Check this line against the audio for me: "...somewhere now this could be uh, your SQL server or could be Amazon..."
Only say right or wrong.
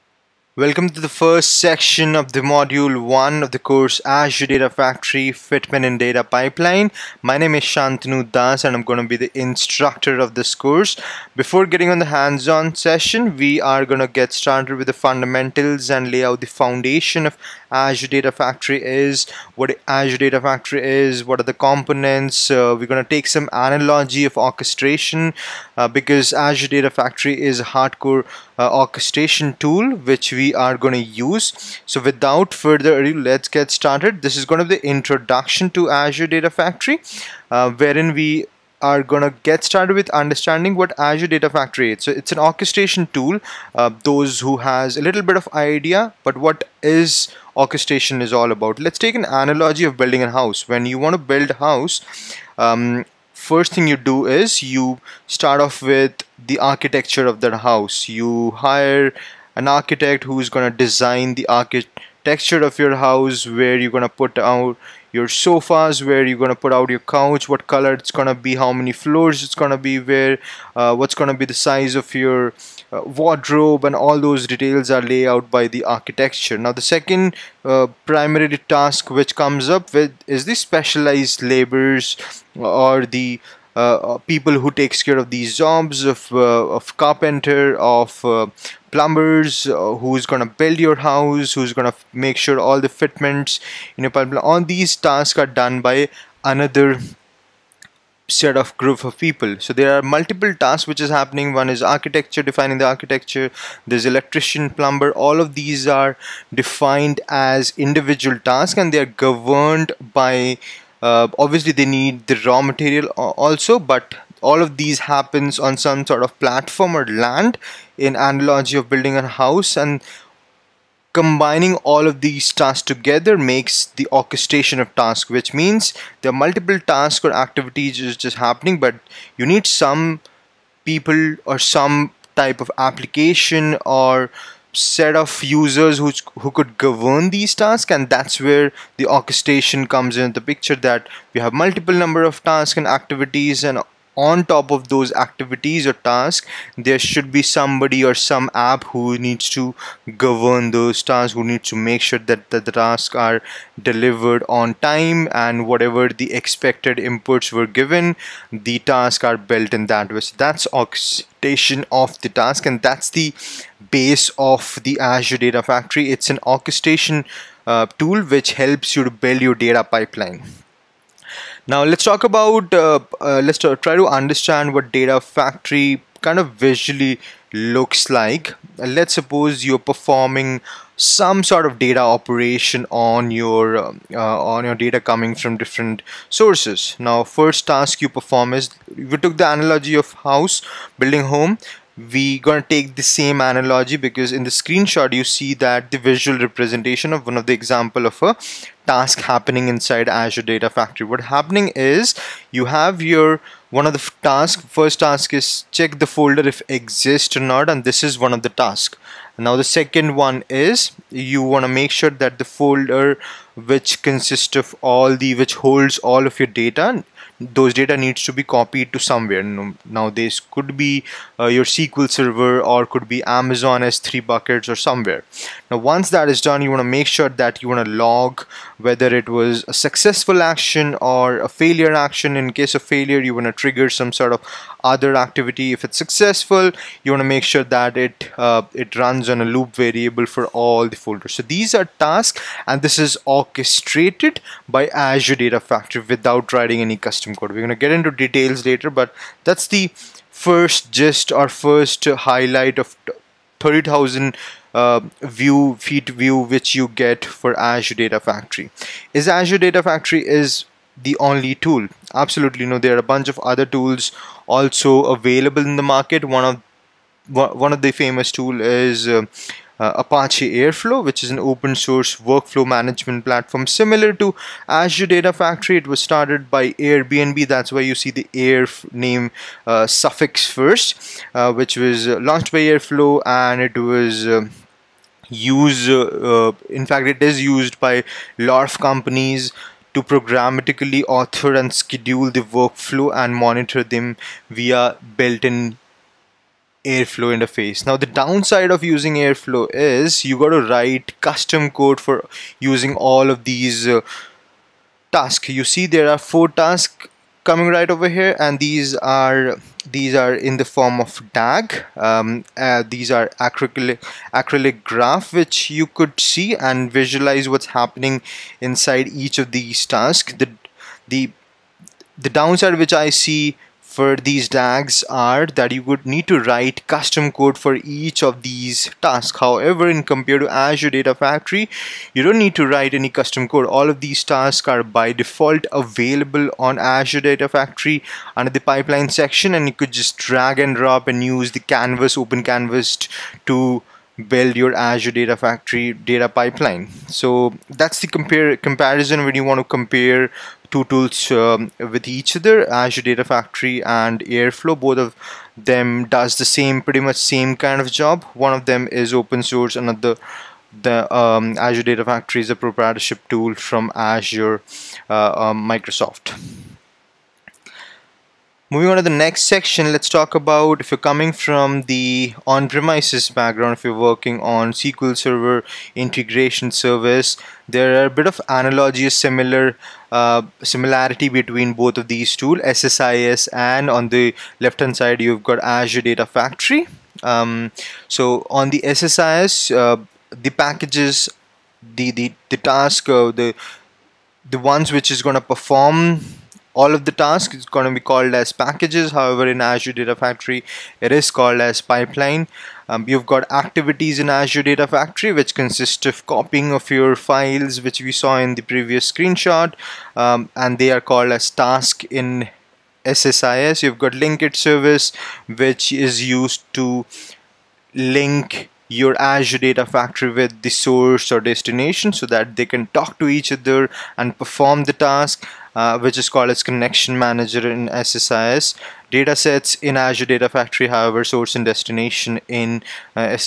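right.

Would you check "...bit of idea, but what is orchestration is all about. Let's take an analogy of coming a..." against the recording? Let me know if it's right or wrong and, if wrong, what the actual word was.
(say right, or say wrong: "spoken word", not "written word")
wrong: "building", not "coming".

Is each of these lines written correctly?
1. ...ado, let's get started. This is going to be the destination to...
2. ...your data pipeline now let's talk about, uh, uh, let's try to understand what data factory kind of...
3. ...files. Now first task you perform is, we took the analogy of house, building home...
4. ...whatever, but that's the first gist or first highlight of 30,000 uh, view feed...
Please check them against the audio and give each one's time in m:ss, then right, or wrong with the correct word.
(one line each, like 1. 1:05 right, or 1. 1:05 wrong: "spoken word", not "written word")
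1. 0:33 wrong: "introduction", not "destination"
2. 2:49 right
3. 3:06 wrong: "sources", not "files"
4. 4:08 wrong: "later", not "whatever".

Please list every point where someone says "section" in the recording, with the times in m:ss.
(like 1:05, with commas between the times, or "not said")
0:01, 5:39, 6:09.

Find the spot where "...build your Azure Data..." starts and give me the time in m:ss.
5:44.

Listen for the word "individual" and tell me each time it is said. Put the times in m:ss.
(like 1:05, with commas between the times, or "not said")
1:47.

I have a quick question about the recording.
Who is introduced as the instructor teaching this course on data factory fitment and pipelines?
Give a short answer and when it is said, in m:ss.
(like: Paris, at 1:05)
Shantanu Das, at 0:07.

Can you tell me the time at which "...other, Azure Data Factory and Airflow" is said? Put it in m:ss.
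5:52.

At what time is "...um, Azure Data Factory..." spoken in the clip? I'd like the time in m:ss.
6:01.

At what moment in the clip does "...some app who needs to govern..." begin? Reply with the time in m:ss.
2:28.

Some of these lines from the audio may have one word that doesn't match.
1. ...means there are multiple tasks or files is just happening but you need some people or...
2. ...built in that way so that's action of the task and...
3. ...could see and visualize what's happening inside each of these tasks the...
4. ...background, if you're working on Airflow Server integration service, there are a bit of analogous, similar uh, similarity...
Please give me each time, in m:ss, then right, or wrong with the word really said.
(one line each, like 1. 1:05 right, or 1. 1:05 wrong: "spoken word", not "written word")
1. 2:05 wrong: "activities", not "files"
2. 2:39 wrong: "orchestration", not "action"
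3. 5:15 right
4. 6:13 wrong: "SQL", not "Airflow".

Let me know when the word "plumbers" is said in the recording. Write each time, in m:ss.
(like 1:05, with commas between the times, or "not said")
1:28, 1:44.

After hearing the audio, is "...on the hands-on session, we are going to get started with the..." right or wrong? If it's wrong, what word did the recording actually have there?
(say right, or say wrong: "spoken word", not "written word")
right.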